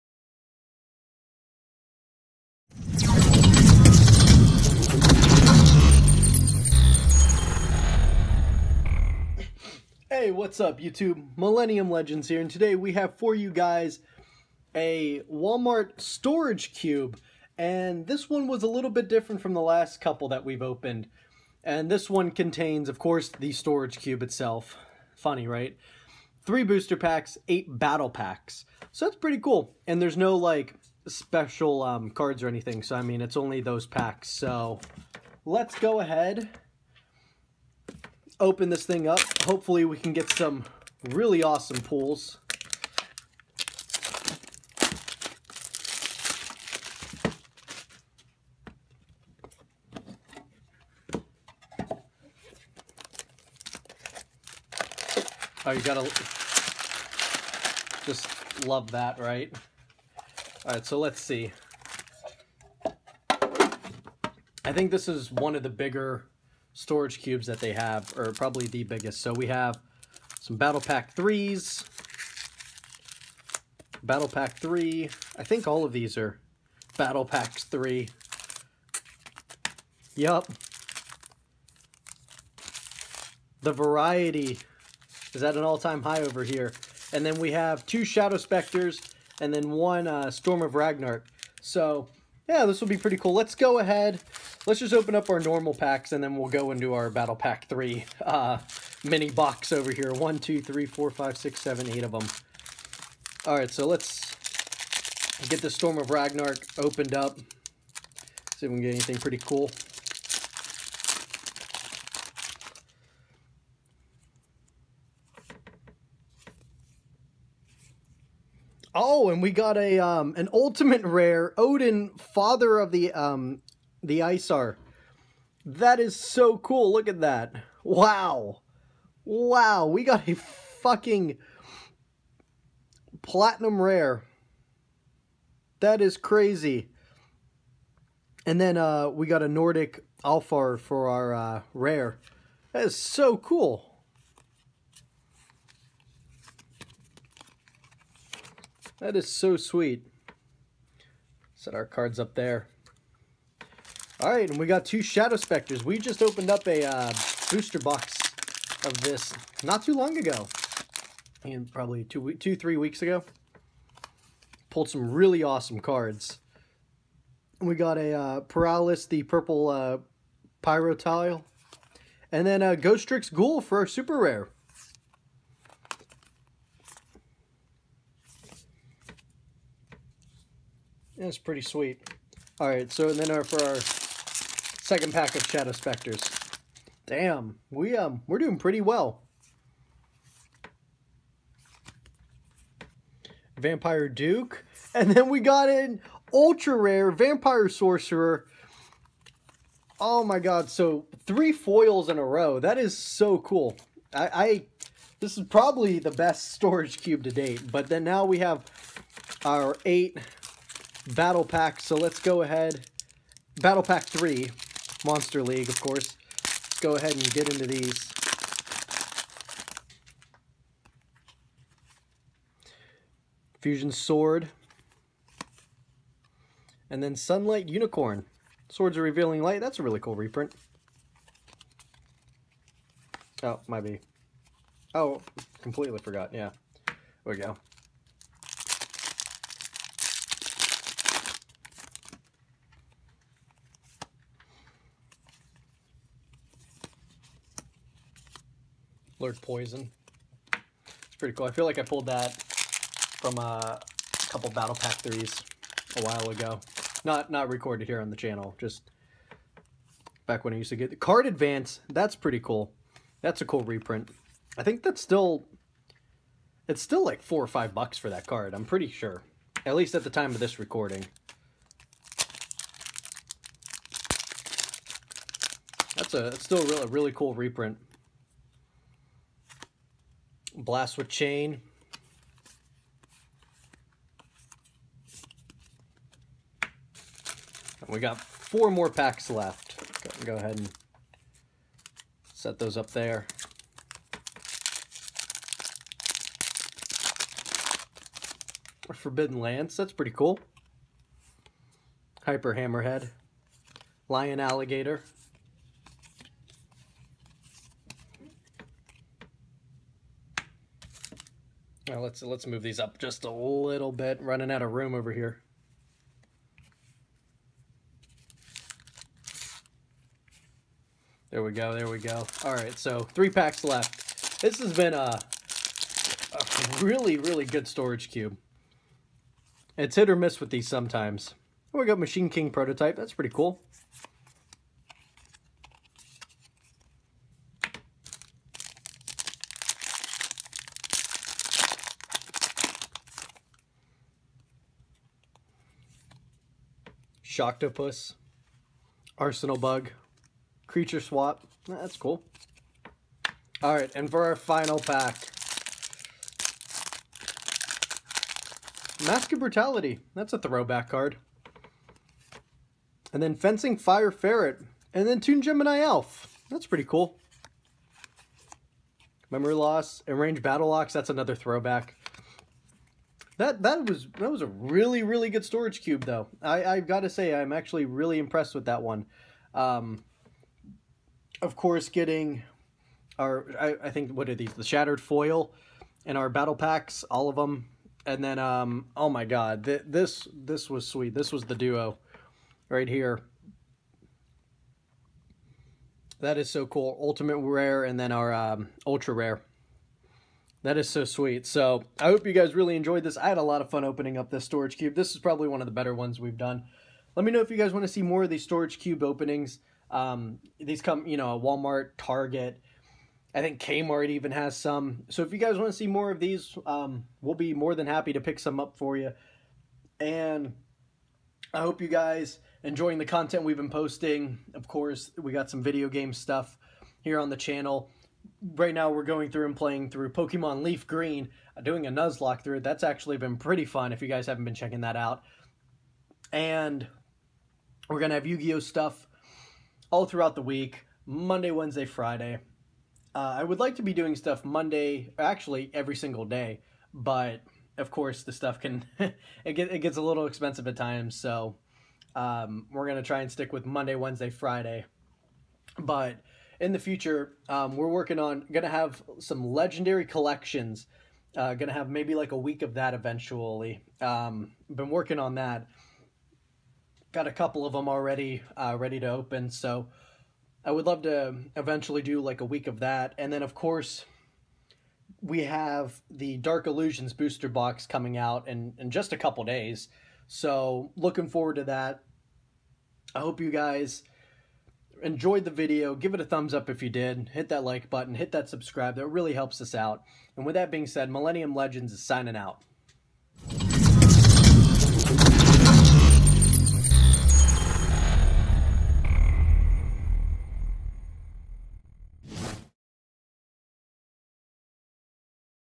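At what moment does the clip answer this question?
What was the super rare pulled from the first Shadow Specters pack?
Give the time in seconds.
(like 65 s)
172 s.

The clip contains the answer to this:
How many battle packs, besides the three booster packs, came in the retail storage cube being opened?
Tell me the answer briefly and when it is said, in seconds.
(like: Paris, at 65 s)
8, at 27 s.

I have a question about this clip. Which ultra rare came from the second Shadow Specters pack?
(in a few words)
Vampire Sorcerer.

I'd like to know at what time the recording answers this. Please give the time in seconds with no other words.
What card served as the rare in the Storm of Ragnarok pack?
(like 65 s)
139 s.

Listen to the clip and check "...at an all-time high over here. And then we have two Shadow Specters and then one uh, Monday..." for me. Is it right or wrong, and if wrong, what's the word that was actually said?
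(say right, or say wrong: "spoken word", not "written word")
wrong: "Storm", not "Monday".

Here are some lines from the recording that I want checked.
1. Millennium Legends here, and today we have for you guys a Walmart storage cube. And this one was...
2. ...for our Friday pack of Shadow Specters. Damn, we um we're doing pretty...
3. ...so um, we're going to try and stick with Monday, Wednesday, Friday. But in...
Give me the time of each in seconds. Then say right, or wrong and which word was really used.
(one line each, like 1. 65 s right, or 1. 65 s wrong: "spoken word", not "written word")
1. 11 s right
2. 183 s wrong: "Second", not "Friday"
3. 451 s right.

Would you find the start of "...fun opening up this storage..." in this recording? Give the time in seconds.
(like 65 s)
403 s.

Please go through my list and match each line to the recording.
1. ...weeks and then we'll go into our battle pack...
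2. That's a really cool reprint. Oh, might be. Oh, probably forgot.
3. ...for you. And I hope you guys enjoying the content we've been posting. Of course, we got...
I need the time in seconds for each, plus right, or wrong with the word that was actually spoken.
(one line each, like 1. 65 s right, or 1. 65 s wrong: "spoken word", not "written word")
1. 95 s wrong: "packs", not "weeks"
2. 229 s wrong: "completely", not "probably"
3. 418 s right.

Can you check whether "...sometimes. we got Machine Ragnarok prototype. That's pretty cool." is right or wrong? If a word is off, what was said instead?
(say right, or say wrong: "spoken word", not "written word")
wrong: "King", not "Ragnarok".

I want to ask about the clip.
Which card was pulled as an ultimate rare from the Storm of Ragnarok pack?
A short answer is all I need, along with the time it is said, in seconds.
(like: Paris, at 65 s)
Odin, at 121 s.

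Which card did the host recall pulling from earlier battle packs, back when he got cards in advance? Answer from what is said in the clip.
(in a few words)
Lord Poison.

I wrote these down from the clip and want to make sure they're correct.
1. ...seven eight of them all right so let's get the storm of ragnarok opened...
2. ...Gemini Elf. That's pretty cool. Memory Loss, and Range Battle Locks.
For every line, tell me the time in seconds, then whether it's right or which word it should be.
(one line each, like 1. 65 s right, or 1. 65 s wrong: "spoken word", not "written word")
1. 101 s right
2. 365 s right.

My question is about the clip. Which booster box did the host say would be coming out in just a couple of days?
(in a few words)
Dark Illusions.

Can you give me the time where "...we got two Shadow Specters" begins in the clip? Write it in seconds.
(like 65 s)
154 s.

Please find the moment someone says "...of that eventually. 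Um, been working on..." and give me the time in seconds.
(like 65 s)
462 s.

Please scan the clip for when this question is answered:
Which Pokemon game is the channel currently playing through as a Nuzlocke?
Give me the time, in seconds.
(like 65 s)
430 s.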